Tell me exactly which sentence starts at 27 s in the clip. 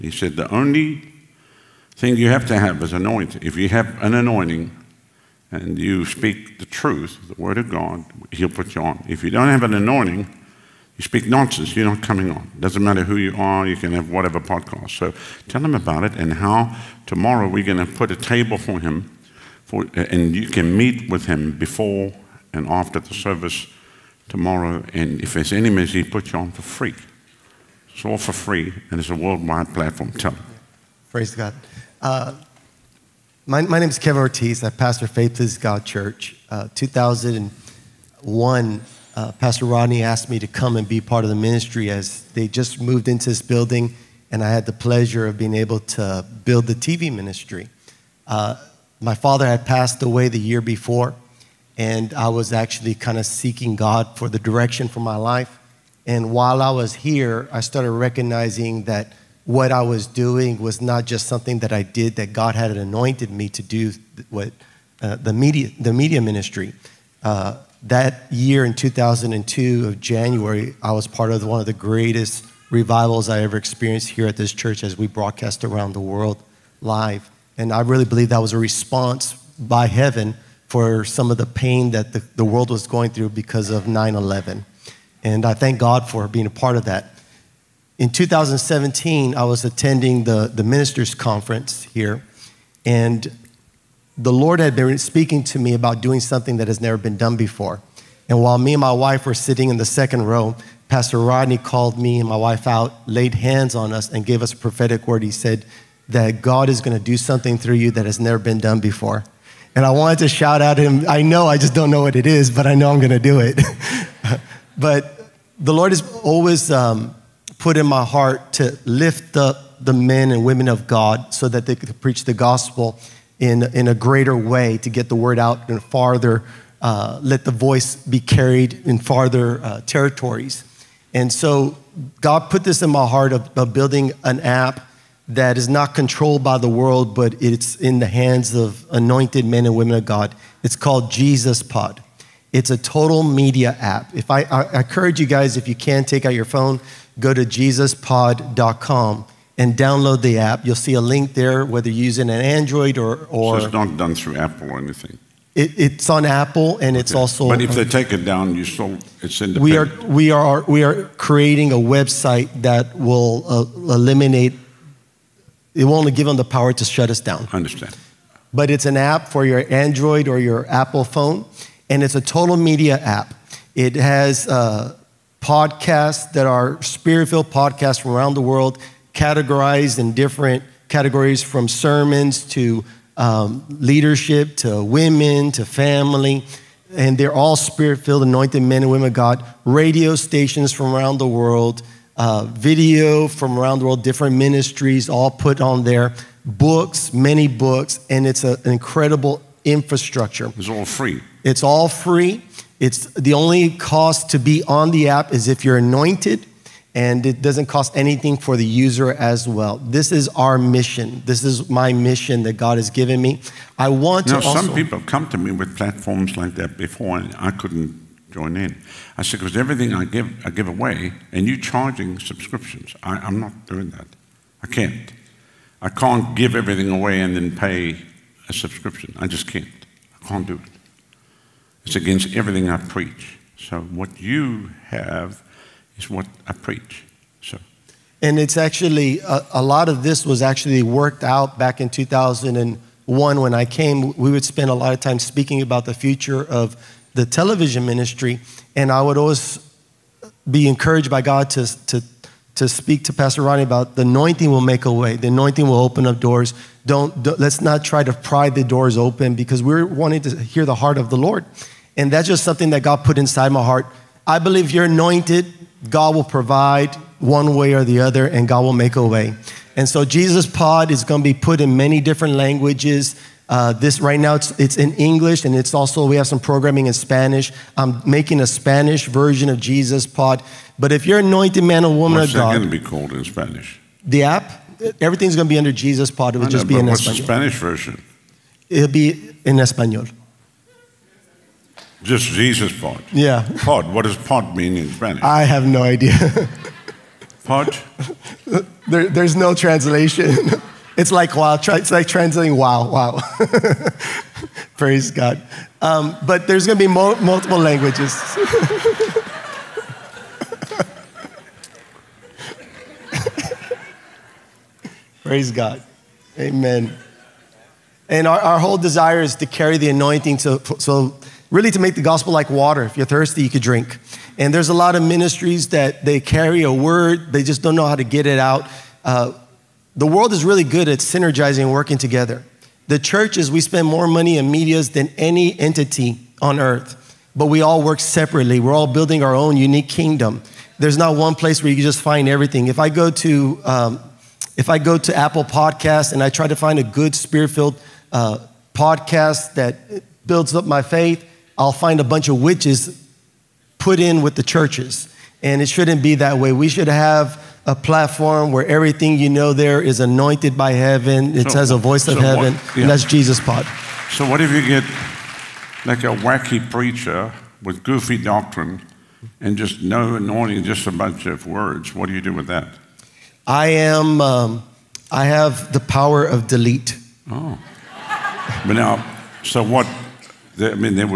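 It's all for free and it's a worldwide platform.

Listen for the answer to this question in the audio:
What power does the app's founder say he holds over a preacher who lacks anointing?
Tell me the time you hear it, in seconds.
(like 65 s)
375 s.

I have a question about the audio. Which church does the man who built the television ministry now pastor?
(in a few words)
Faith Is God Church.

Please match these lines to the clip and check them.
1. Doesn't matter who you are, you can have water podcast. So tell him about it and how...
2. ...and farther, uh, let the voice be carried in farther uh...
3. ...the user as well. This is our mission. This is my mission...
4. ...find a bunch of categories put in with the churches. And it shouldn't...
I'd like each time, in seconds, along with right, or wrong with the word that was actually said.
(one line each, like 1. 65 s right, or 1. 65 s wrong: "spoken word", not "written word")
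1. 12 s wrong: "whatever", not "water"
2. 125 s right
3. 208 s right
4. 351 s wrong: "witches", not "categories".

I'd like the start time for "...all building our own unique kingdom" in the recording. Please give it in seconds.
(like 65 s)
338 s.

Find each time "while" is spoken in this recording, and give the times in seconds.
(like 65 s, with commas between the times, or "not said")
56 s, 98 s.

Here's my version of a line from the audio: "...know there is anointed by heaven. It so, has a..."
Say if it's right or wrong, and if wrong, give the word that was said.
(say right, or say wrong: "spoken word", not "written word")
right.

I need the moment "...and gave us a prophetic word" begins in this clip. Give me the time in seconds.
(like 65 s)
104 s.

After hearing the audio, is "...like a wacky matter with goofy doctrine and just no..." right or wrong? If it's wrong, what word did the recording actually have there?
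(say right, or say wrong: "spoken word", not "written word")
wrong: "preacher", not "matter".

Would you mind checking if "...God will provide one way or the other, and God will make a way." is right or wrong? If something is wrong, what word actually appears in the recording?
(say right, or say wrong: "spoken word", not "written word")
right.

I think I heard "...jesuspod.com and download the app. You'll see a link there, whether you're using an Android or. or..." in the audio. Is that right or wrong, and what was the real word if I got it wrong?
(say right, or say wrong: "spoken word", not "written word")
right.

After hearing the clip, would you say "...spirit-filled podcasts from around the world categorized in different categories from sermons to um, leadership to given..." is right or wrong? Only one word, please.
wrong.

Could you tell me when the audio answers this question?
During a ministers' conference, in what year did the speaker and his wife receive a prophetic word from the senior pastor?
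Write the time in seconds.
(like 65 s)
88 s.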